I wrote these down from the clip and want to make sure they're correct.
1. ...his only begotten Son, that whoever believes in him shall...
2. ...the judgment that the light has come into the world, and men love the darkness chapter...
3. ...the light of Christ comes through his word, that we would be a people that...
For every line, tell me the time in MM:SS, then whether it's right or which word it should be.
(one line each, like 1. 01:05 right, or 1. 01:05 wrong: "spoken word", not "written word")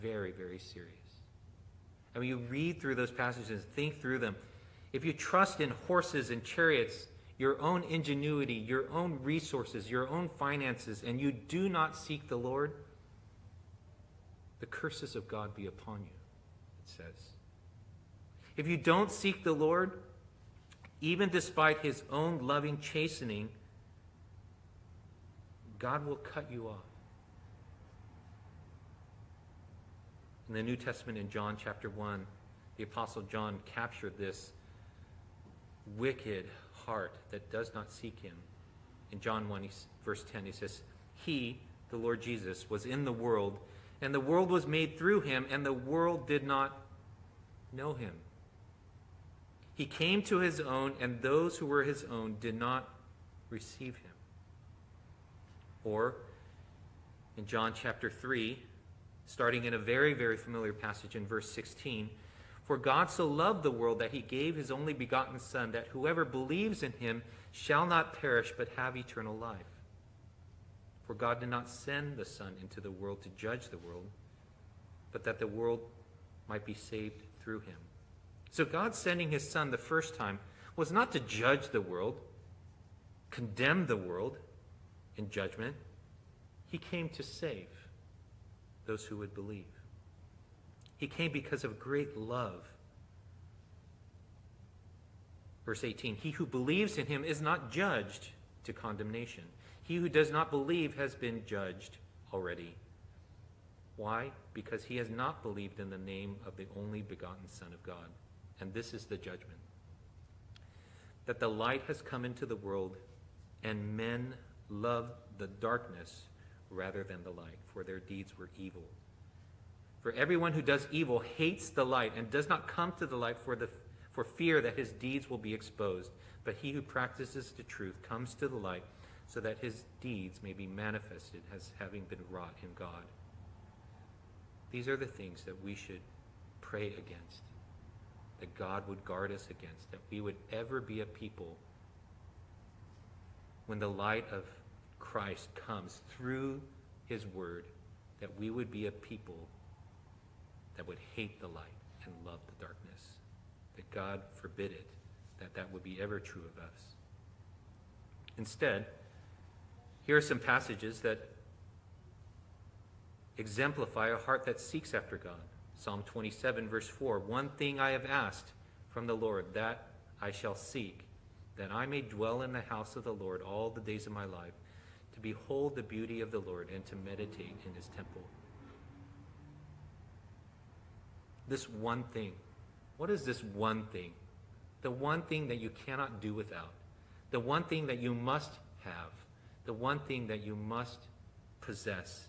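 1. 01:04 right
2. 01:49 wrong: "rather", not "chapter"
3. 02:23 right.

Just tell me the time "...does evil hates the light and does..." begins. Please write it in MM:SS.
02:00.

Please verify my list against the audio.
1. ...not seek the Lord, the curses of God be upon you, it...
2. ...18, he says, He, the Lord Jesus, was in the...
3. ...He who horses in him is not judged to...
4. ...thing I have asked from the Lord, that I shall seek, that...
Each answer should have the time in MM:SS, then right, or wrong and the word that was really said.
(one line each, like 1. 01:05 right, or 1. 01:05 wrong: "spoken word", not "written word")
1. 00:11 right
2. 00:40 wrong: "10", not "18"
3. 01:36 wrong: "believes", not "horses"
4. 02:47 right.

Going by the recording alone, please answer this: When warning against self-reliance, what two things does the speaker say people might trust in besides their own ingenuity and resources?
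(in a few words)
horses and chariots.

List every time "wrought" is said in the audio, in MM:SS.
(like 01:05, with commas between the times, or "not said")
02:12.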